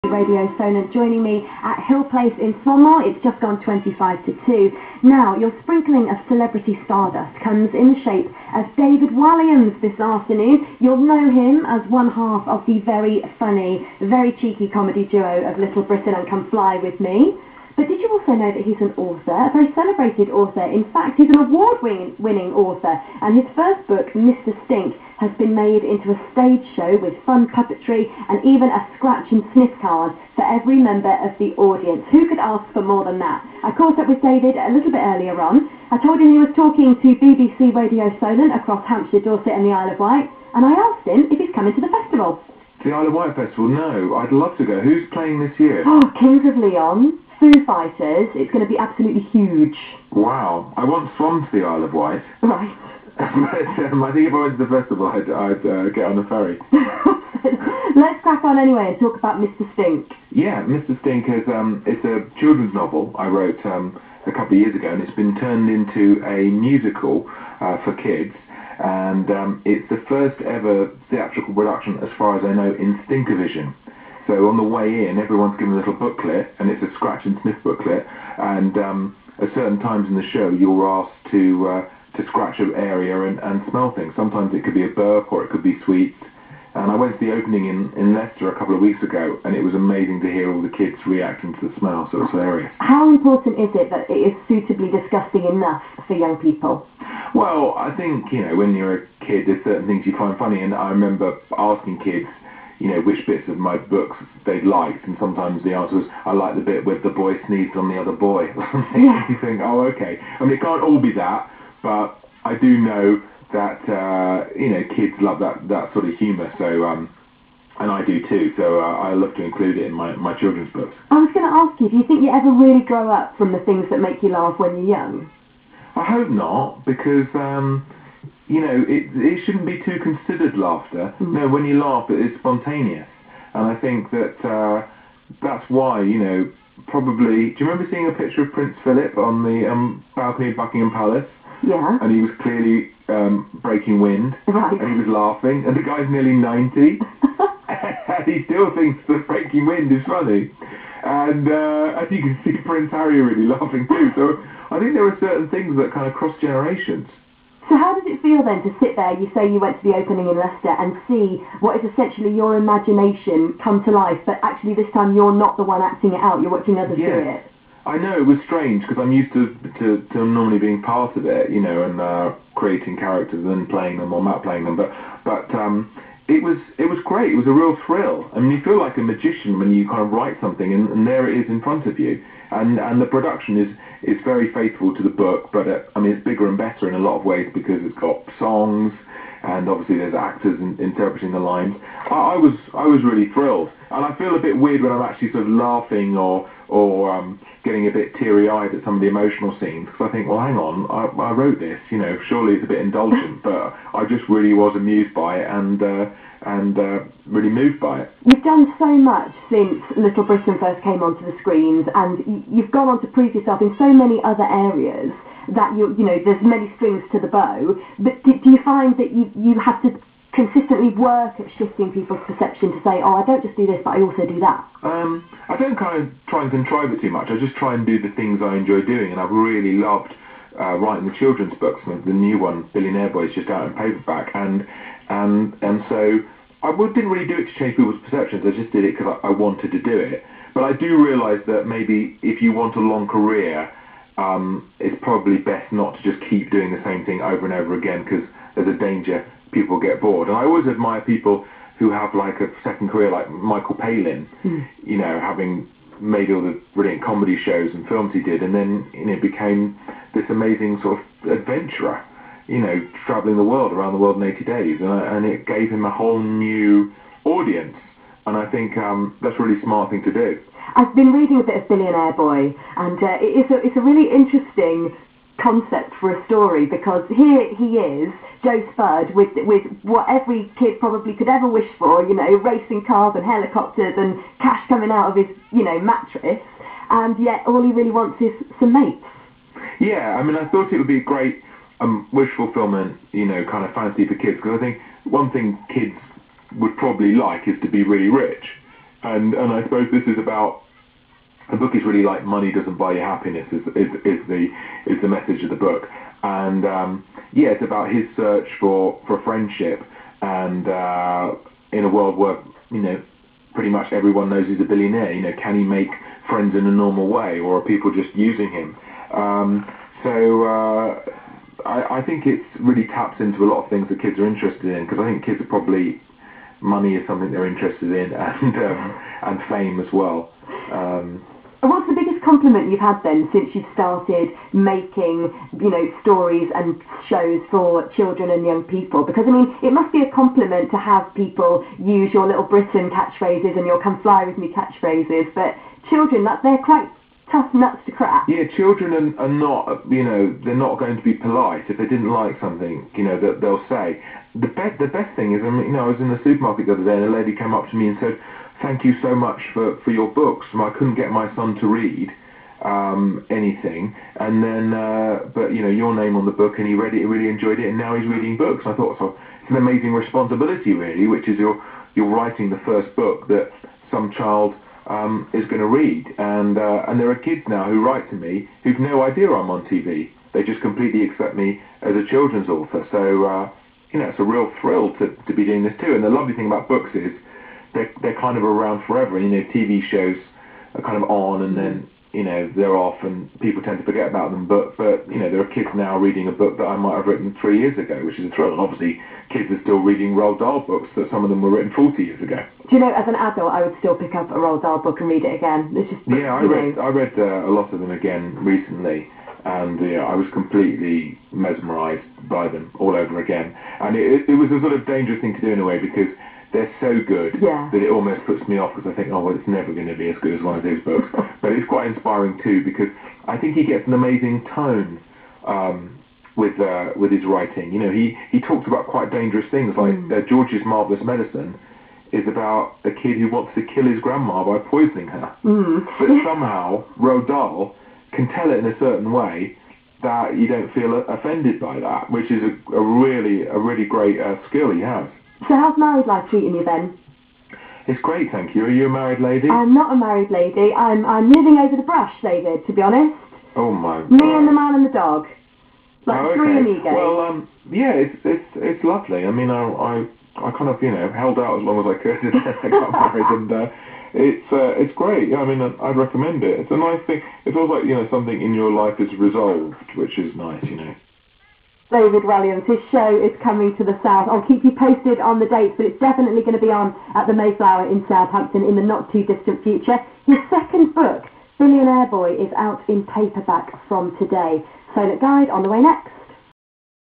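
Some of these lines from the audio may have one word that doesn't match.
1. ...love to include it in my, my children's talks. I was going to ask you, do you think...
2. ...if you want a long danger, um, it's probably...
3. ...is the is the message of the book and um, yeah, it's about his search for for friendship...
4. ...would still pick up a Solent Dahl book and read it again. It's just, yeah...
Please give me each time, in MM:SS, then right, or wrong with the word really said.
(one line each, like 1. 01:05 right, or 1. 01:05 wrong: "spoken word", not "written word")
1. 01:59 wrong: "books", not "talks"
2. 04:02 wrong: "career", not "danger"
3. 05:04 right
4. 06:43 wrong: "Roald", not "Solent".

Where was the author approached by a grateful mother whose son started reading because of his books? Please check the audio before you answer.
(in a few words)
the supermarket.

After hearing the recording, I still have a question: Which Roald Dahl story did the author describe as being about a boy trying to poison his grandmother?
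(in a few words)
George's Marvelous Medicine.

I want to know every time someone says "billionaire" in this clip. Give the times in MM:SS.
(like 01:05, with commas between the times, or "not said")
03:52, 04:31, 05:14, 08:01.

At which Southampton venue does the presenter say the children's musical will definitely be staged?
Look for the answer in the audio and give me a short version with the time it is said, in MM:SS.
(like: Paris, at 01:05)
the Mayflower, at 07:57.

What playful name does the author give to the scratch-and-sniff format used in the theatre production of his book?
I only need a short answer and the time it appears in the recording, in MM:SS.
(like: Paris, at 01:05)
Stinkervision, at 01:13.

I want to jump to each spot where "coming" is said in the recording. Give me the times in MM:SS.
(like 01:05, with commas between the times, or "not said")
00:41, 04:44, 07:53.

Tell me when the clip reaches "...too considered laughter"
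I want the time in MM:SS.
02:09.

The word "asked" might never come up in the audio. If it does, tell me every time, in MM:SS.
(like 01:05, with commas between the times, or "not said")
00:40, 01:20.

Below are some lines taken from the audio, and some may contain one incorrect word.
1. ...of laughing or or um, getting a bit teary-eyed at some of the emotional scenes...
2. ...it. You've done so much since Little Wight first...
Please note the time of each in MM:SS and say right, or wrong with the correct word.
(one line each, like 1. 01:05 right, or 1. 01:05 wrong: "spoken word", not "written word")
1. 03:15 right
2. 03:28 wrong: "Britain", not "Wight".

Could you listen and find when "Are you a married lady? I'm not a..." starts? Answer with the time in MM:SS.
07:28.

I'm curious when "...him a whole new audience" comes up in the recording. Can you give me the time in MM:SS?
04:25.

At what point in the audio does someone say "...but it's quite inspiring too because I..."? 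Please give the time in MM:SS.
07:01.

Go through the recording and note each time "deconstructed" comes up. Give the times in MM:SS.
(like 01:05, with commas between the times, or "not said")
not said.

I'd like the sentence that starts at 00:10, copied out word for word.
You'll know him as one half of the very funny, very cheeky comedy duo of Little Britain and Come Fly With Me.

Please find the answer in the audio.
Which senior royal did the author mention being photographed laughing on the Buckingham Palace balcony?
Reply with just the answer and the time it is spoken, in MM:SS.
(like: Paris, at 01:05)
Prince Philip, at 02:18.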